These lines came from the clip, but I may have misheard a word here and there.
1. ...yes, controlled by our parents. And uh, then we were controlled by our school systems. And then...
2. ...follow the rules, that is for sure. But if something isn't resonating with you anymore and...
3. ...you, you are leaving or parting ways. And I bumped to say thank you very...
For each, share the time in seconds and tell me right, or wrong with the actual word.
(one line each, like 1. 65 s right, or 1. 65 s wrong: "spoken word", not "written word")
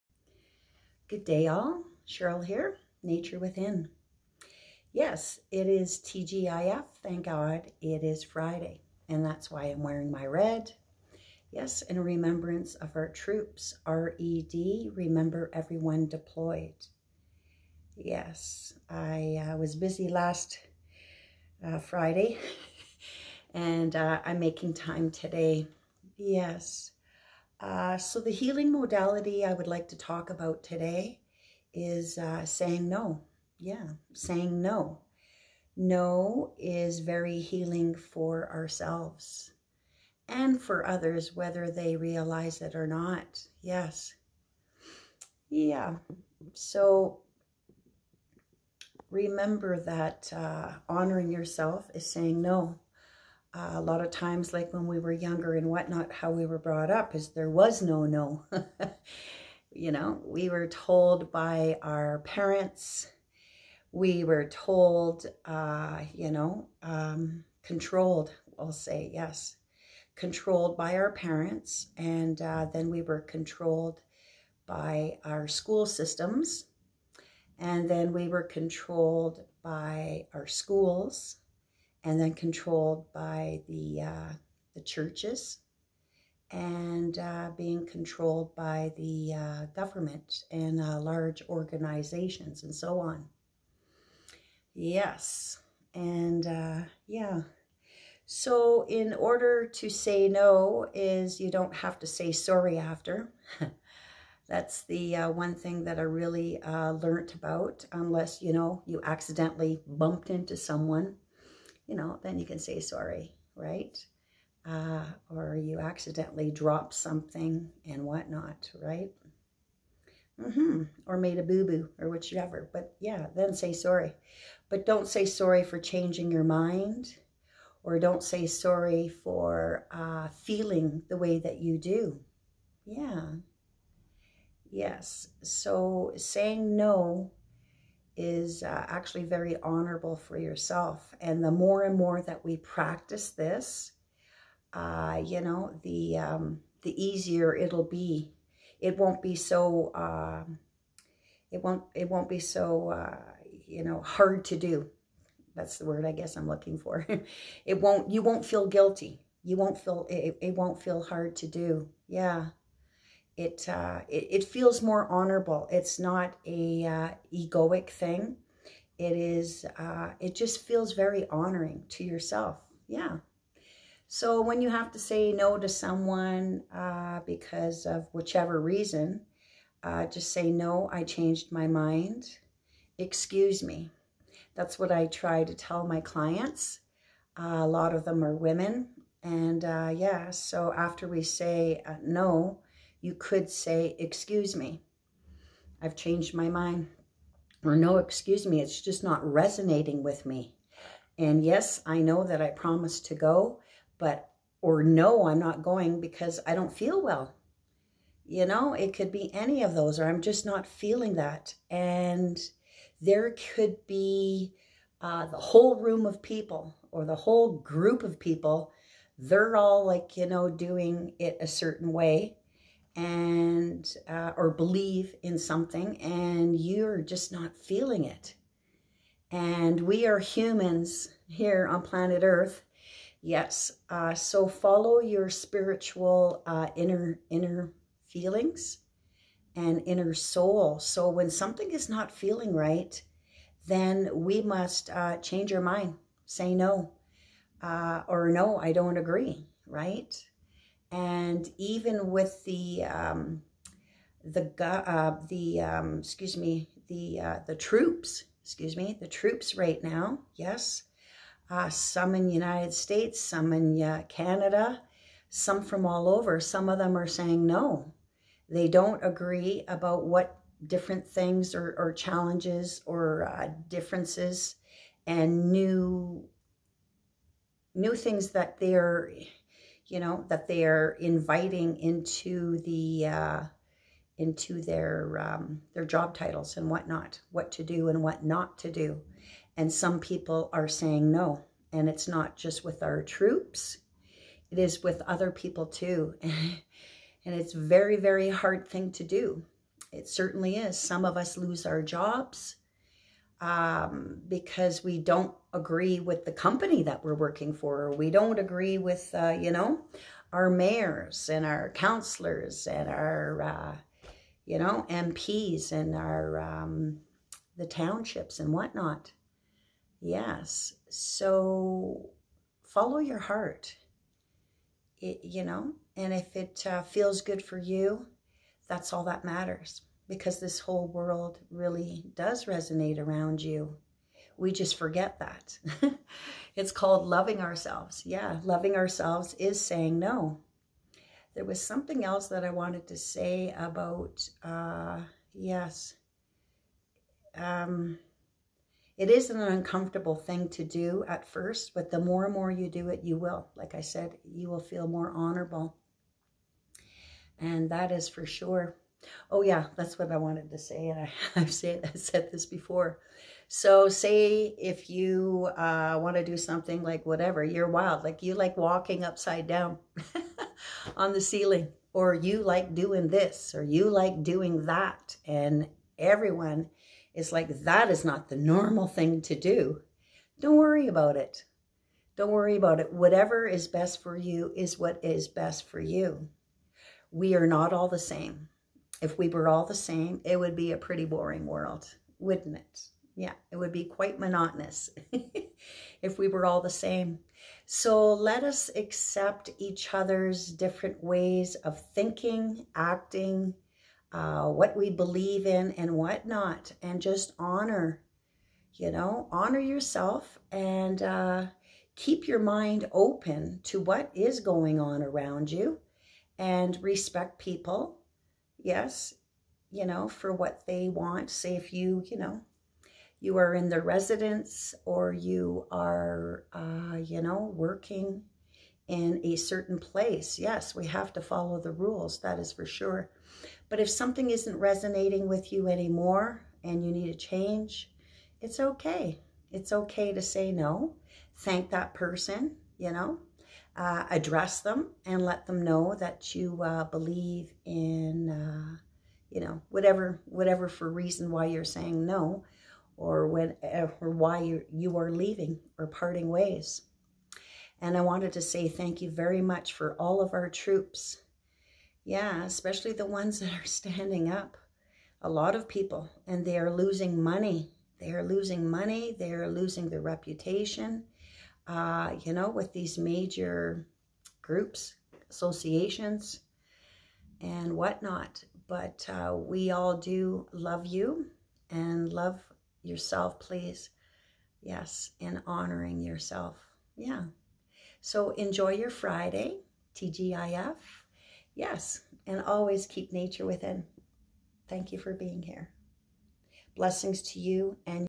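1. 69 s right
2. 431 s right
3. 454 s wrong: "wanted", not "bumped".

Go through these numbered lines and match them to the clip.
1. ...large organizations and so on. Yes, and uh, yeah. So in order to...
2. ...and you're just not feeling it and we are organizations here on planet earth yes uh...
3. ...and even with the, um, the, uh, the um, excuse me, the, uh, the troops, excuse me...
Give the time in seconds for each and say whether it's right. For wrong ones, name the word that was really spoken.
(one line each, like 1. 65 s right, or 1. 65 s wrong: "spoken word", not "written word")
1. 90 s right
2. 226 s wrong: "humans", not "organizations"
3. 250 s right.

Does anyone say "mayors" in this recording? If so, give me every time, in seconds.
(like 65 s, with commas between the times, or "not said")
310 s.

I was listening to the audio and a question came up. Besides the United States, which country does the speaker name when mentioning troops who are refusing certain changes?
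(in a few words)
Canada.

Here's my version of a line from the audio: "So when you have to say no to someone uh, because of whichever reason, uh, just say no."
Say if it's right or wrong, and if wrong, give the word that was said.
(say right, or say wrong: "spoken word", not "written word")
right.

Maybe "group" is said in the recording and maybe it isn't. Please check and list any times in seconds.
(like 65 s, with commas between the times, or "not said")
217 s, 474 s.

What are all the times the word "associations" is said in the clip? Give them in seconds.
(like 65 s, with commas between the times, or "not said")
475 s.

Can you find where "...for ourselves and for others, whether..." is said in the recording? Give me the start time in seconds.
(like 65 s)
37 s.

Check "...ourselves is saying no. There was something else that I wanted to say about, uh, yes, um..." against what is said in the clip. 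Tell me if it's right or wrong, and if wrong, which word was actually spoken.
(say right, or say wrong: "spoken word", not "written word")
right.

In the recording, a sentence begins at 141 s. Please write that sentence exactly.
And the more and more that we practice this, uh, you know, the, um, the easier it'll be.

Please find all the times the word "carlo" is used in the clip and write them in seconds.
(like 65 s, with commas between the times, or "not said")
not said.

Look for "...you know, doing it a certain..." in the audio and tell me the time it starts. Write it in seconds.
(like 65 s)
220 s.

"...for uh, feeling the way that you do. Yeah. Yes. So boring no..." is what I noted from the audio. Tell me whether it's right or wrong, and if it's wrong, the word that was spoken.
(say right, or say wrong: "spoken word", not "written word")
wrong: "saying", not "boring".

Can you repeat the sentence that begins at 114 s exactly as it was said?
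Uh, or you accidentally dropped something and whatnot, right?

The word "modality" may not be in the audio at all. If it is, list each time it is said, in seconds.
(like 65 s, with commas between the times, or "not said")
28 s.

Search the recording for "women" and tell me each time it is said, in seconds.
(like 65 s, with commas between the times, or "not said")
188 s.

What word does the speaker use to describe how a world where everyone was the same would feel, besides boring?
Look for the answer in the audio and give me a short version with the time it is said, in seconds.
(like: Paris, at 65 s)
Monotonous, at 394 s.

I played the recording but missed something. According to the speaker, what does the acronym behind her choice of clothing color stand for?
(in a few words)
Remember everyone deployed.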